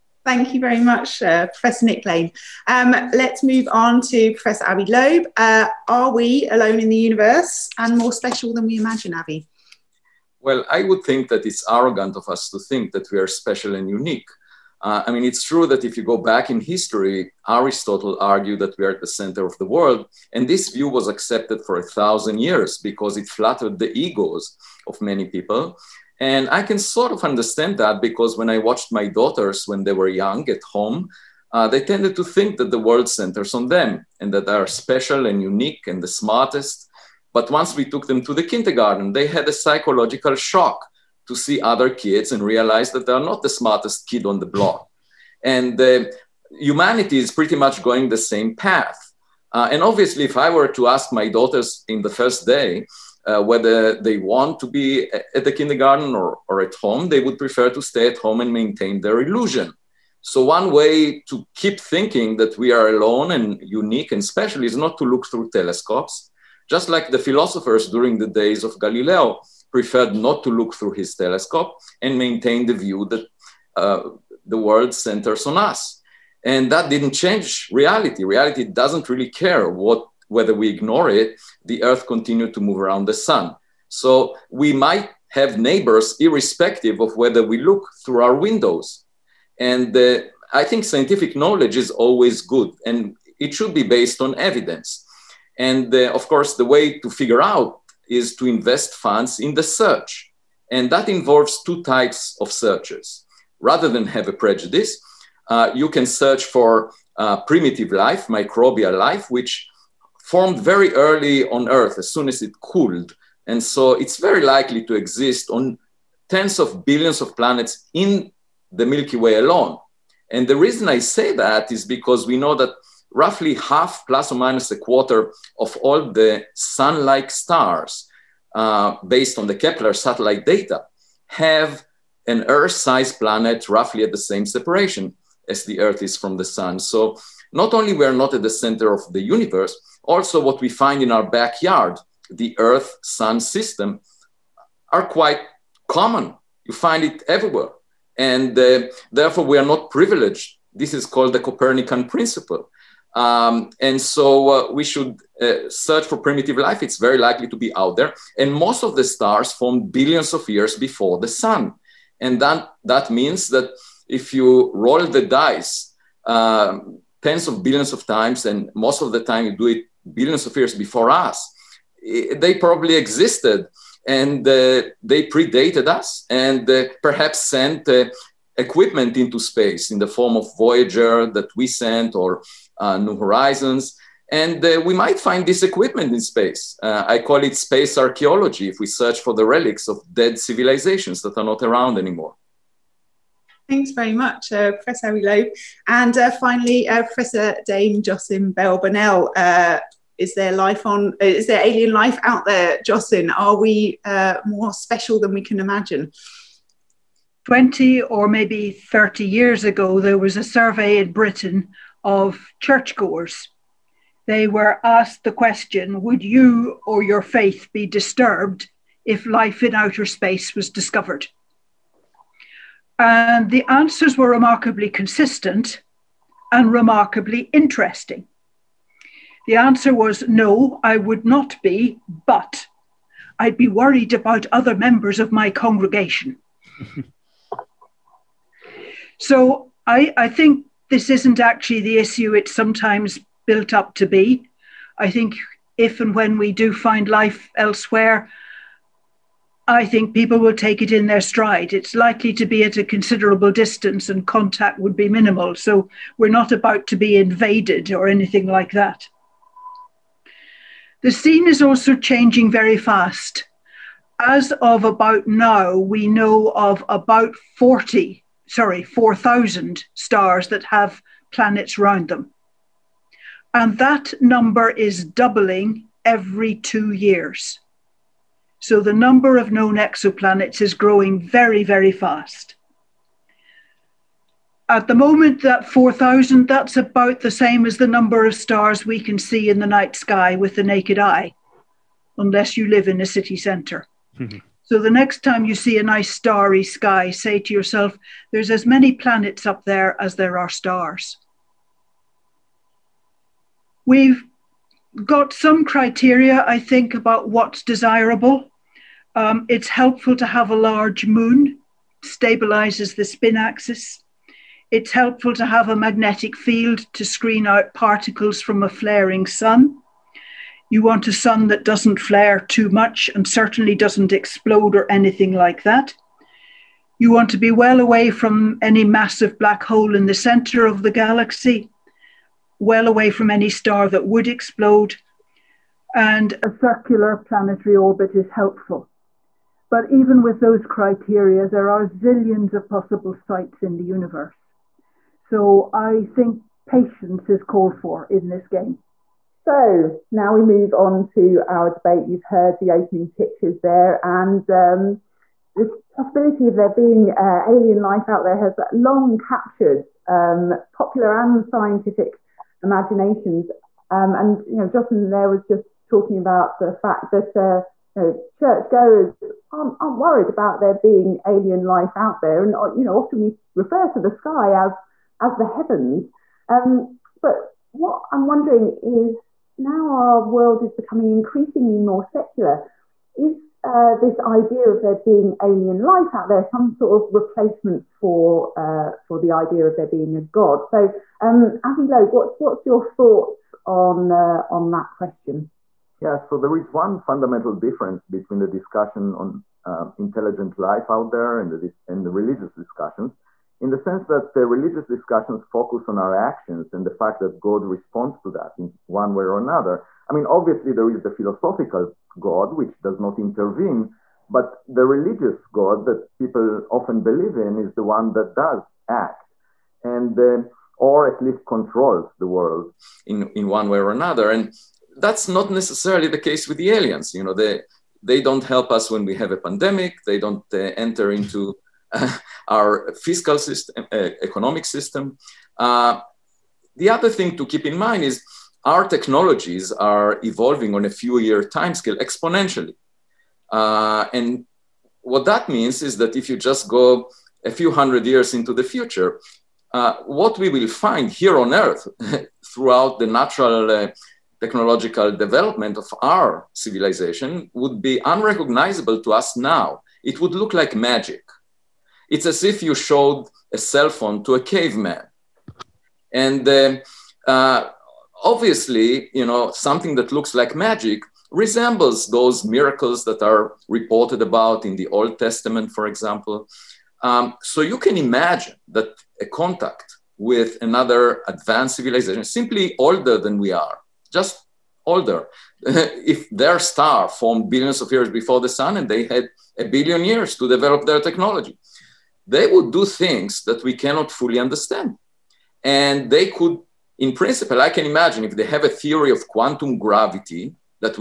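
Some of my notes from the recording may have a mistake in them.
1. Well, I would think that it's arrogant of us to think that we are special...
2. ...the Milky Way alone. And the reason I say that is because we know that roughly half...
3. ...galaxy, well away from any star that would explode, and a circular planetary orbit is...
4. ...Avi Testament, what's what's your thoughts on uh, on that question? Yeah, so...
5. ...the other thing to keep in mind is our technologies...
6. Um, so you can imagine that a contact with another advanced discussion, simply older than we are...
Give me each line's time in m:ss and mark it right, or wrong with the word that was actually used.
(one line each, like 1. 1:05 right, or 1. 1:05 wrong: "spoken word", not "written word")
1. 0:10 right
2. 1:58 right
3. 5:30 right
4. 6:31 wrong: "Loeb", not "Testament"
5. 7:16 right
6. 7:57 wrong: "civilization", not "discussion".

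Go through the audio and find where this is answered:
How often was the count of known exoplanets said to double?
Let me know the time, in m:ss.
4:36.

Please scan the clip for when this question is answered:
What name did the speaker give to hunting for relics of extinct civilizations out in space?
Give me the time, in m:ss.
3:07.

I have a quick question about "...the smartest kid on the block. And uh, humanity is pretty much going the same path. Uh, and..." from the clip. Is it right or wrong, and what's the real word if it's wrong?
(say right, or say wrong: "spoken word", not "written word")
right.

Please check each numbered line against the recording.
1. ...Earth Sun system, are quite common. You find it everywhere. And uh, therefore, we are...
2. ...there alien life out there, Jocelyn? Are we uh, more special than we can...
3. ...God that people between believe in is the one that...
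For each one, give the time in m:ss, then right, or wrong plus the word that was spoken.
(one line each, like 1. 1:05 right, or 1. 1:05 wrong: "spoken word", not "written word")
1. 2:22 right
2. 3:21 right
3. 6:55 wrong: "often", not "between".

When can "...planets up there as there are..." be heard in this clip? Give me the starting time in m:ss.
4:58.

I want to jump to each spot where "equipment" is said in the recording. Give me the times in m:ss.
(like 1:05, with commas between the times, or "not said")
2:58, 3:05.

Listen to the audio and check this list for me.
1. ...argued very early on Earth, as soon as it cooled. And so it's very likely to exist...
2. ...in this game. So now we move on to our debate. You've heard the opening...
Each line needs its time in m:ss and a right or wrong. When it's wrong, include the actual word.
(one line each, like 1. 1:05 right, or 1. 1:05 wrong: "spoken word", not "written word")
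1. 1:50 wrong: "formed", not "argued"
2. 5:48 right.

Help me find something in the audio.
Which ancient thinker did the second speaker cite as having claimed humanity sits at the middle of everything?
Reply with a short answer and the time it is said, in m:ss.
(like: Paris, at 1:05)
Aristotle, at 0:17.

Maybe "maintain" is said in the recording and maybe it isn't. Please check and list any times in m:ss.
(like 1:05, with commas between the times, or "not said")
0:58, 1:12.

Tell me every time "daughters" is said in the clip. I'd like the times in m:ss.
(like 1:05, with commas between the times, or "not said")
0:29, 0:51.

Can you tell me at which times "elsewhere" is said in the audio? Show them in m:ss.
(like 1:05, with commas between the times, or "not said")
4:07.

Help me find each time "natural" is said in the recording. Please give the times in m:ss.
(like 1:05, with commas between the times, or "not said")
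7:33.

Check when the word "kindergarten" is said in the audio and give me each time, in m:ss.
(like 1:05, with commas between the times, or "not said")
0:38, 0:55.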